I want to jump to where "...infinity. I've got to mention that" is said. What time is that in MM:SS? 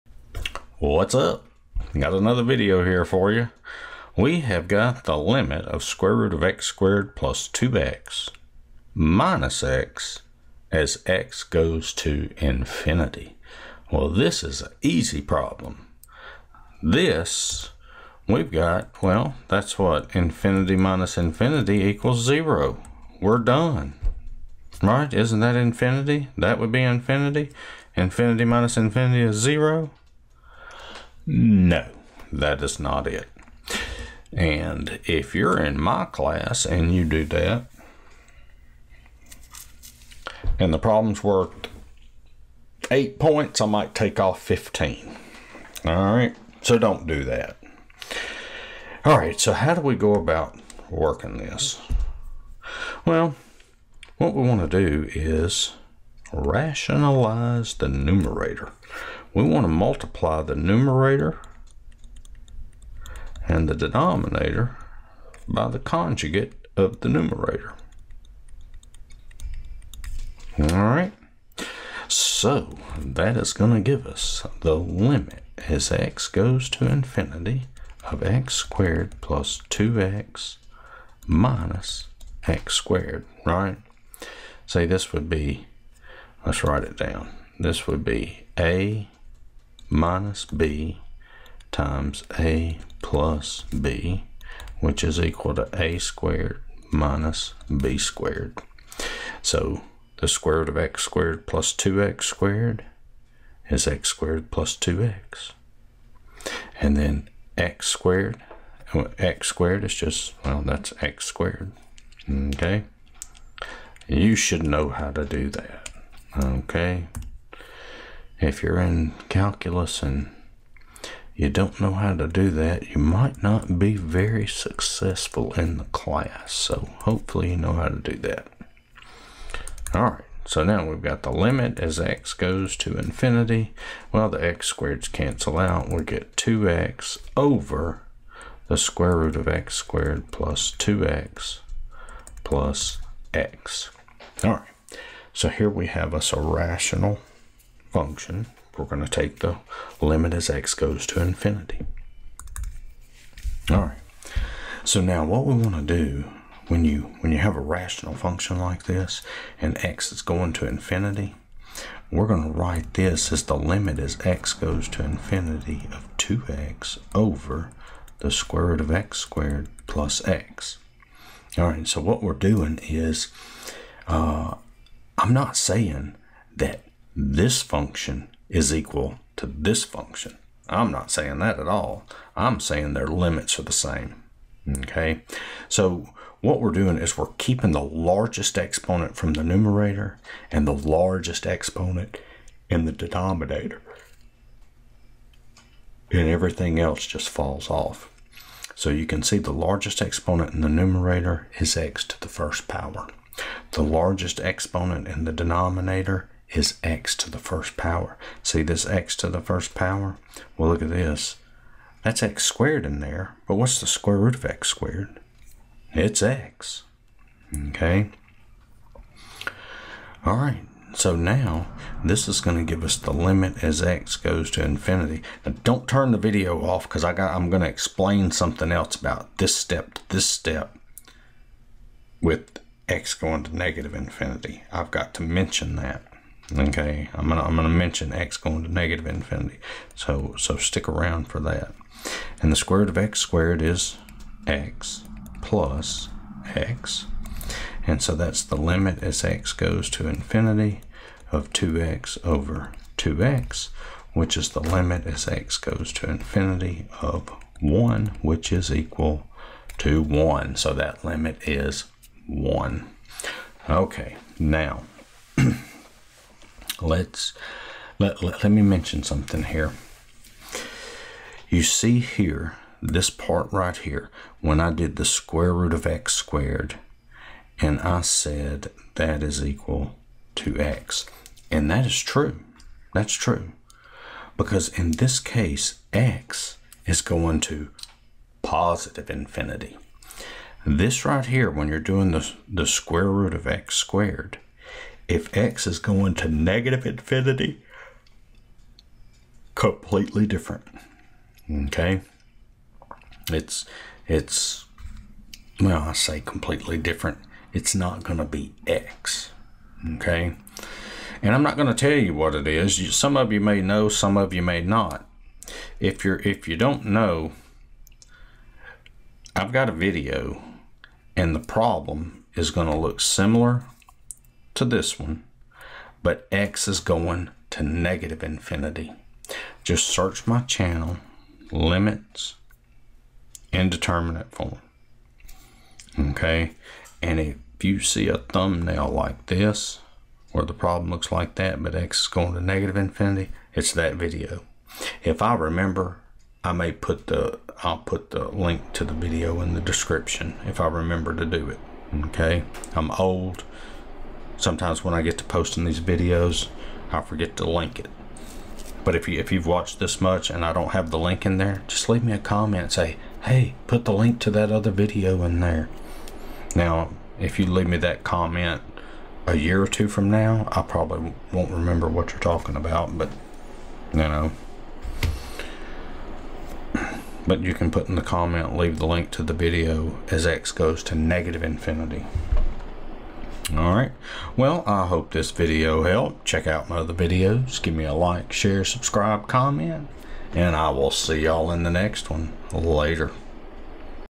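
03:53.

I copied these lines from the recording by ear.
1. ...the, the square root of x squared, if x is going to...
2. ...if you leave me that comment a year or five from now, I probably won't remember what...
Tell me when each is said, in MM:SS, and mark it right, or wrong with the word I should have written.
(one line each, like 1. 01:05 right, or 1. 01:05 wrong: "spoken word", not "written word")
1. 04:52 right
2. 06:07 wrong: "two", not "five".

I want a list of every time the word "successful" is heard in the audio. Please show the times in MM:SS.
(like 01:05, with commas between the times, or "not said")
02:04.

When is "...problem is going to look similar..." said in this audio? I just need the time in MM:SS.
05:21.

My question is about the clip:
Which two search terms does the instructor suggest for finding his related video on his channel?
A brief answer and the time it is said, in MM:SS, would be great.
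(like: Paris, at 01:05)
limits, indeterminate form, at 05:31.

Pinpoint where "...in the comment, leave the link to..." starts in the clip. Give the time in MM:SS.
06:17.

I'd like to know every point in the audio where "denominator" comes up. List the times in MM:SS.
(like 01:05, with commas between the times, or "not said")
01:03, 03:12, 03:25.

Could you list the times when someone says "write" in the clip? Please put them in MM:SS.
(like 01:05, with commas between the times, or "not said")
01:26, 02:42.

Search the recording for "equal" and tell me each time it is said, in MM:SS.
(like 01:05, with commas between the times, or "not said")
00:21, 01:35, 02:58, 04:18, 04:39.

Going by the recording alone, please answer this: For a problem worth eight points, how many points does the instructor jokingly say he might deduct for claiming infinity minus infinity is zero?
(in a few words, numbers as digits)
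15.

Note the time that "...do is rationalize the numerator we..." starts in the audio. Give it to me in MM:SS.
00:54.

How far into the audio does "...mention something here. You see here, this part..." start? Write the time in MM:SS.
04:28.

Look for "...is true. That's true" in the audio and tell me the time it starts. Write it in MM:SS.
04:41.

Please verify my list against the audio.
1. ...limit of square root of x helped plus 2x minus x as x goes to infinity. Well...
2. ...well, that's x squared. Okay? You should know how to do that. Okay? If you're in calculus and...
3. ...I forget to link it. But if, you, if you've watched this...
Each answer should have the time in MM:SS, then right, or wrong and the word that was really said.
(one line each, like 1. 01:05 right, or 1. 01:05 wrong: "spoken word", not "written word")
1. 00:05 wrong: "squared", not "helped"
2. 01:50 right
3. 05:56 right.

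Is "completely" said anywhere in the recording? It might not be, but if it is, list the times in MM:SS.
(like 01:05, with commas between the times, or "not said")
04:59, 05:06.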